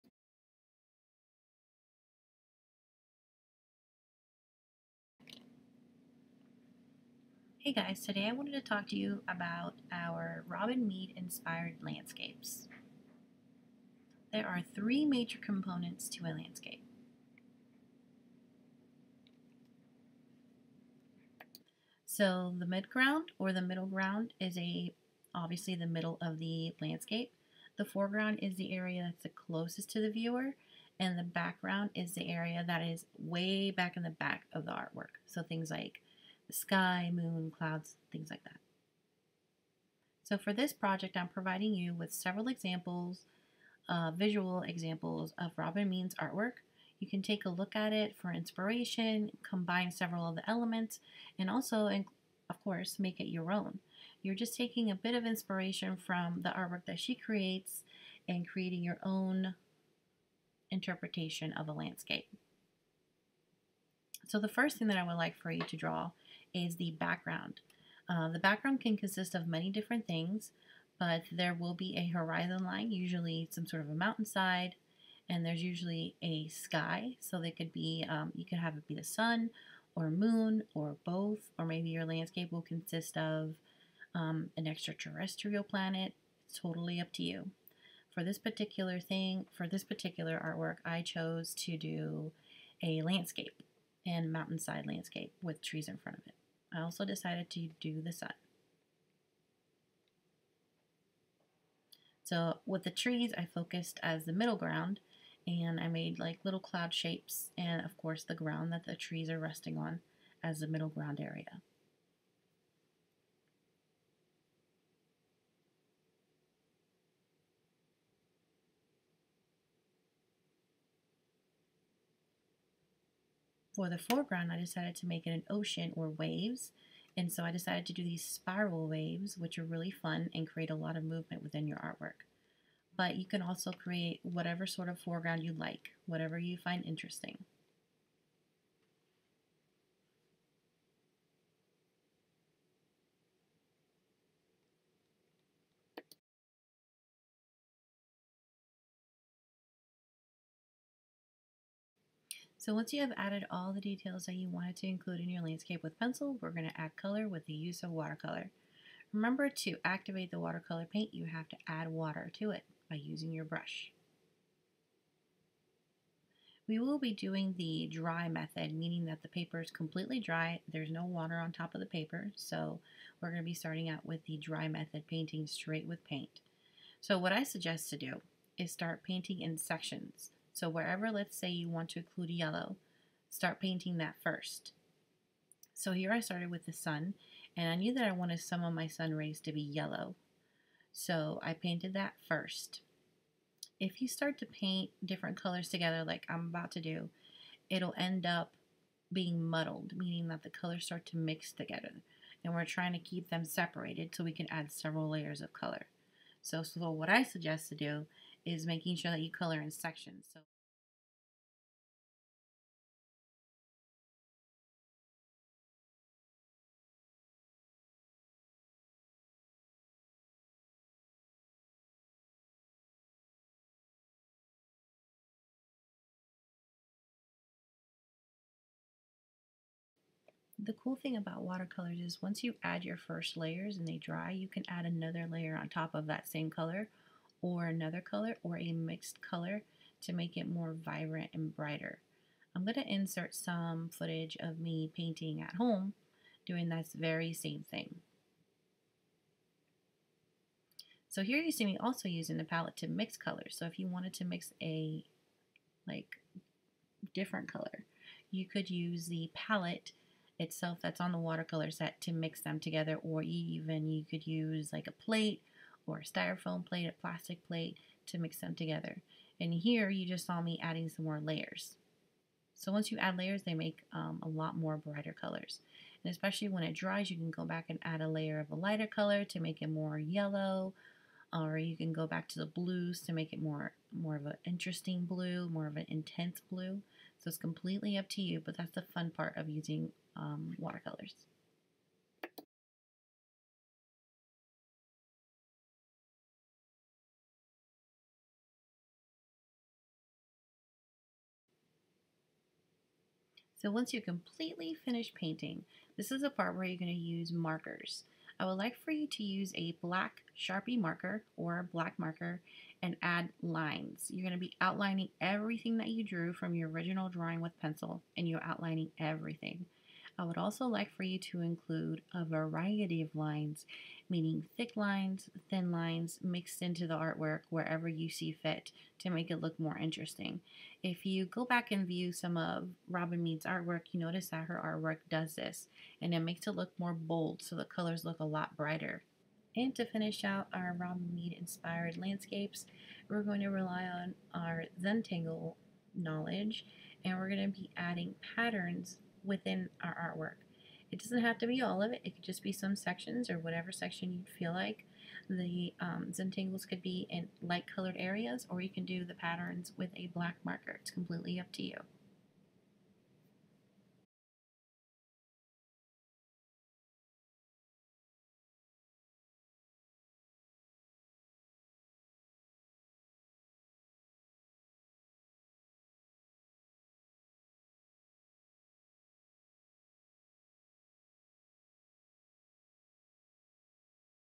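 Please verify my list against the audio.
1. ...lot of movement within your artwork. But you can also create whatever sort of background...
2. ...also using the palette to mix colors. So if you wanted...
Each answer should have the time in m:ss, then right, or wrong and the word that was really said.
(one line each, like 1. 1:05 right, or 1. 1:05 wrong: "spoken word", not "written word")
1. 2:10 wrong: "foreground", not "background"
2. 4:11 right.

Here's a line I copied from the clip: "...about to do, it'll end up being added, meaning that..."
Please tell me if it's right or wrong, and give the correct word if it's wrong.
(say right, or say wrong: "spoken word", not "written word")
wrong: "muddled", not "added".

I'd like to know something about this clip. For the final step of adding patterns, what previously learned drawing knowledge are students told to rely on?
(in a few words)
Zentangle.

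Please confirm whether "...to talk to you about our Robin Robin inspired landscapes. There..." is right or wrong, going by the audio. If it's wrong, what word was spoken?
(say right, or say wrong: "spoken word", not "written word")
wrong: "Mead", not "Robin".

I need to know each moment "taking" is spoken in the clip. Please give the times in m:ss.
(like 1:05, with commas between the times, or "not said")
0:54.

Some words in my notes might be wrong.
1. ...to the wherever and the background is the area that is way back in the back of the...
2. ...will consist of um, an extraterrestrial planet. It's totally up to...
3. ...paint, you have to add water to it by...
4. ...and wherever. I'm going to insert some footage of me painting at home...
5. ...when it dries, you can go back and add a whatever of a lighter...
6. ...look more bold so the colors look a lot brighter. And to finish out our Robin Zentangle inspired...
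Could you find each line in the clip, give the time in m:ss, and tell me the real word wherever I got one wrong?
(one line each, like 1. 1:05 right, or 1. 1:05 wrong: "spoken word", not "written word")
1. 0:29 wrong: "viewer", not "wherever"
2. 1:22 right
3. 2:40 right
4. 4:01 wrong: "brighter", not "wherever"
5. 4:36 wrong: "layer", not "whatever"
6. 5:36 wrong: "Mead", not "Zentangle".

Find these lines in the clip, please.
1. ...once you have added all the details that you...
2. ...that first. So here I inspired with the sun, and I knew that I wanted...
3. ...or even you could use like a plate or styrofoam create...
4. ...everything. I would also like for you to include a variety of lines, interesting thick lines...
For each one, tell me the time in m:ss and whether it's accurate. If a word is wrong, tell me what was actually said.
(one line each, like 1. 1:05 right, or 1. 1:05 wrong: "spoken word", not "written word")
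1. 2:32 right
2. 3:03 wrong: "started", not "inspired"
3. 4:23 wrong: "plate", not "create"
4. 5:18 wrong: "meaning", not "interesting".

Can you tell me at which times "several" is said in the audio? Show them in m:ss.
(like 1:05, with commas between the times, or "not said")
0:42, 0:49, 3:24.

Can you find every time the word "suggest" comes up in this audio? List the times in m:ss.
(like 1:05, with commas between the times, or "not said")
2:57, 3:27.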